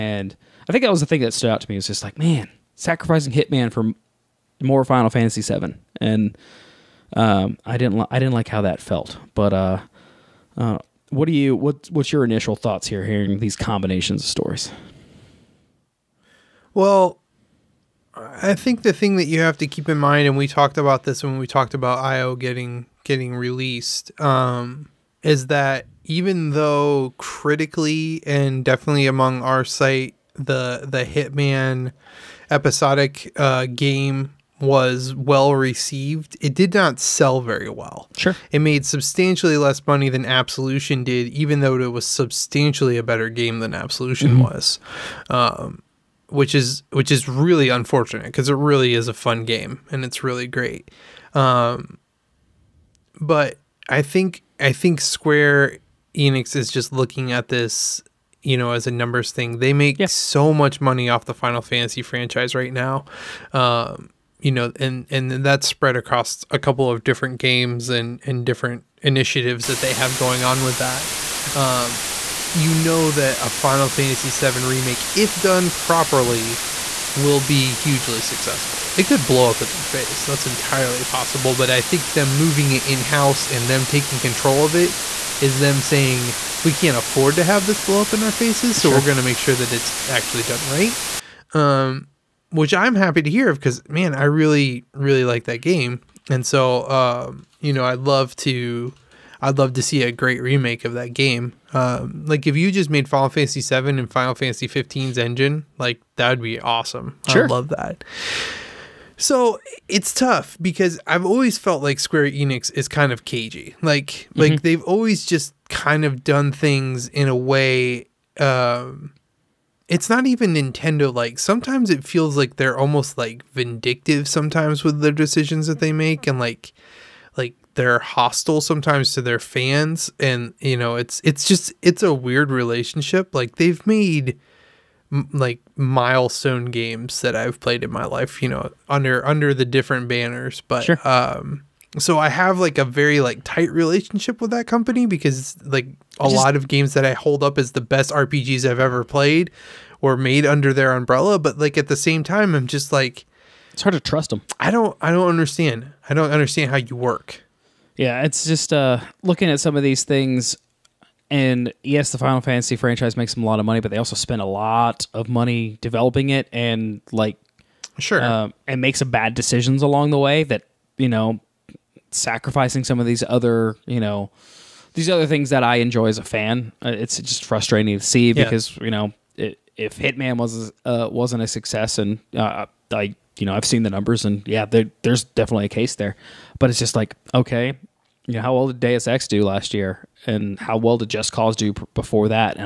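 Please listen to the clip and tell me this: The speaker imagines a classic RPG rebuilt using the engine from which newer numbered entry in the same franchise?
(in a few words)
Final Fantasy 15.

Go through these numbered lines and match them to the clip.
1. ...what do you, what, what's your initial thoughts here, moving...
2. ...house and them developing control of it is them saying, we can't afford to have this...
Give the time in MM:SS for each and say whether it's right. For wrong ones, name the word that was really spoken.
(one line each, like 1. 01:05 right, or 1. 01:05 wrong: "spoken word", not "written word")
1. 00:11 wrong: "hearing", not "moving"
2. 01:23 wrong: "taking", not "developing".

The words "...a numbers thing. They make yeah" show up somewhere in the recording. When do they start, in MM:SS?
00:58.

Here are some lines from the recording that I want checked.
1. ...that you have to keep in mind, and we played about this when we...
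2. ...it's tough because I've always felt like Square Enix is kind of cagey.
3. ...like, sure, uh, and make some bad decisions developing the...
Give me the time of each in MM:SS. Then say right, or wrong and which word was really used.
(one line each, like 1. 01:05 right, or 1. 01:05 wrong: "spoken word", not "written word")
1. 00:19 wrong: "talked", not "played"
2. 01:49 right
3. 02:47 wrong: "along", not "developing".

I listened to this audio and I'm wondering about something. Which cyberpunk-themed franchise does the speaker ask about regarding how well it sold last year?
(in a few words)
Deus Ex.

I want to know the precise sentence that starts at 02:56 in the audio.
Uh, it's just frustrating to see because yeah.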